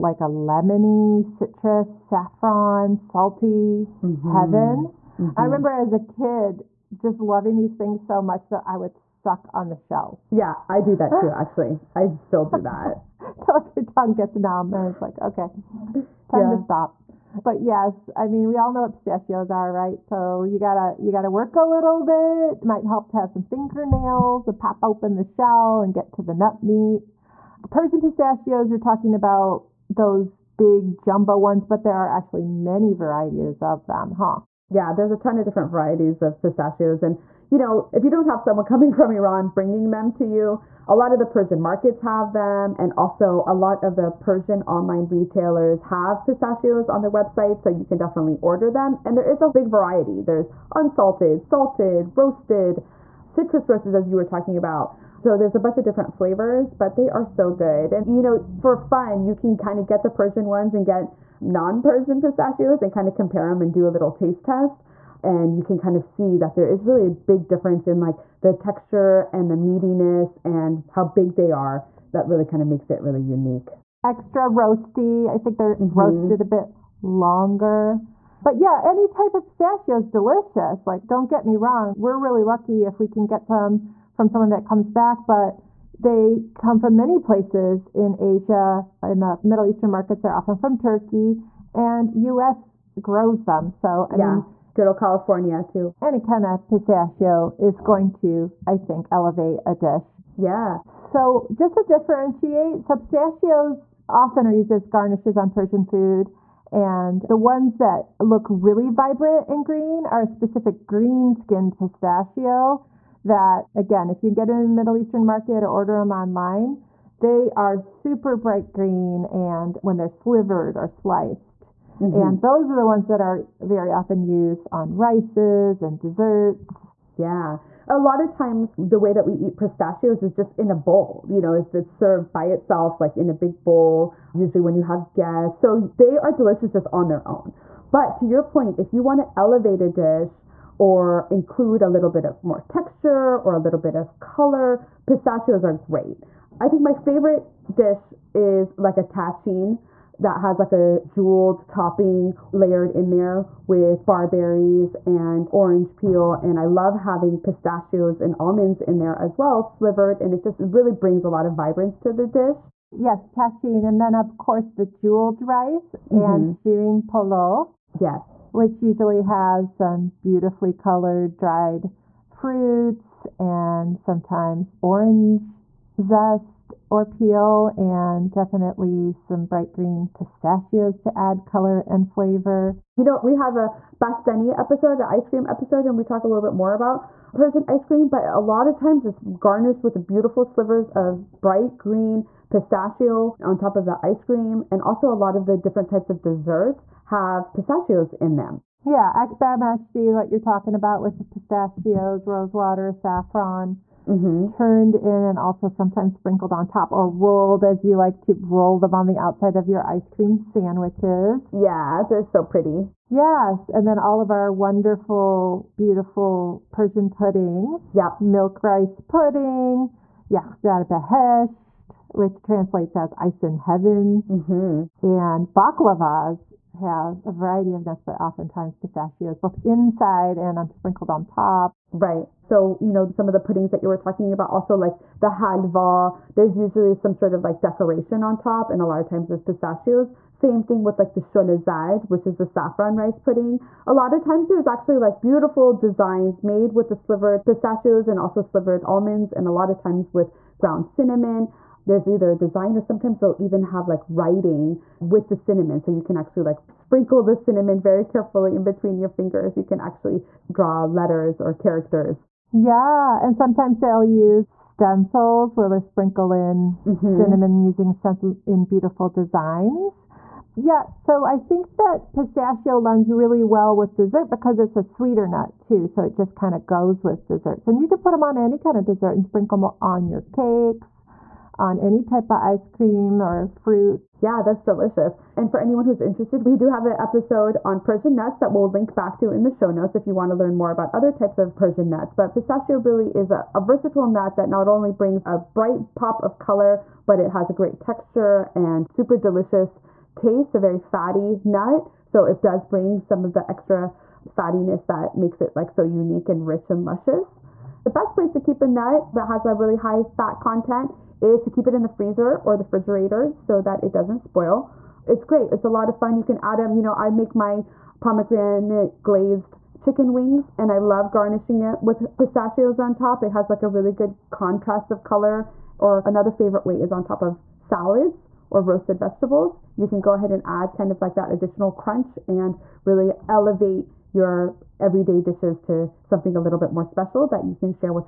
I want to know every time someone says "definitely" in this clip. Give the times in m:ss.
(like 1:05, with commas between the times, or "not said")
0:47, 2:58.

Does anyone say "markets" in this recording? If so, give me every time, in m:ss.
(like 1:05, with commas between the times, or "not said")
0:41, 1:29, 1:55.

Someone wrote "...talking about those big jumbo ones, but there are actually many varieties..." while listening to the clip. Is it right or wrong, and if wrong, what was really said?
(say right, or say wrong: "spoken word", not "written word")
right.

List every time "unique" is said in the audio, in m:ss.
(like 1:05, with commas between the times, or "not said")
1:13, 5:05.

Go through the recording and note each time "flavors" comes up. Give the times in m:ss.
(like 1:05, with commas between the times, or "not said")
0:56, 3:02.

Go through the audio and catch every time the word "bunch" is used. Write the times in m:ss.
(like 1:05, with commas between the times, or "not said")
0:55.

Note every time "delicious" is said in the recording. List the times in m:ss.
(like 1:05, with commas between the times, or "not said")
1:20, 2:16, 4:44, 4:59.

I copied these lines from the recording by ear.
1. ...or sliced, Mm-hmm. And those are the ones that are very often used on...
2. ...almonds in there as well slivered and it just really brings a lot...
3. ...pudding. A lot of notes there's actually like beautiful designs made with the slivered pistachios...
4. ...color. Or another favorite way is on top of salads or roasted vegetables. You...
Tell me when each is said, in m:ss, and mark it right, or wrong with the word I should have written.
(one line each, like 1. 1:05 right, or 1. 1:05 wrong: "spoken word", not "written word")
1. 2:00 right
2. 2:38 right
3. 4:03 wrong: "times", not "notes"
4. 5:25 right.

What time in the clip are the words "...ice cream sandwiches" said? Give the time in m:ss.
3:29.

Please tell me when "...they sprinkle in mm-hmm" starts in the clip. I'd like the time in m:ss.
4:25.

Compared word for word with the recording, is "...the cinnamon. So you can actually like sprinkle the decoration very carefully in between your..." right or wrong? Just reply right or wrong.
wrong.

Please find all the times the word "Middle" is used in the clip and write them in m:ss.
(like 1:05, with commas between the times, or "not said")
1:29, 1:54.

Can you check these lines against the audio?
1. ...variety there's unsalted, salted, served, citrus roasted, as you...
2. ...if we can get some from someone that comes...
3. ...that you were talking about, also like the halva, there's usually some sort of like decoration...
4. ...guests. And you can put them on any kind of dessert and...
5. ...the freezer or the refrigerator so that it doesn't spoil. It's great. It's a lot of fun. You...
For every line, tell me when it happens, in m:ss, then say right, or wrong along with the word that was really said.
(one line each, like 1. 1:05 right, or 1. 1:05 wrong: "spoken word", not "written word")
1. 0:49 wrong: "roasted", not "served"
2. 1:22 right
3. 3:53 right
4. 4:37 wrong: "desserts", not "guests"
5. 5:11 right.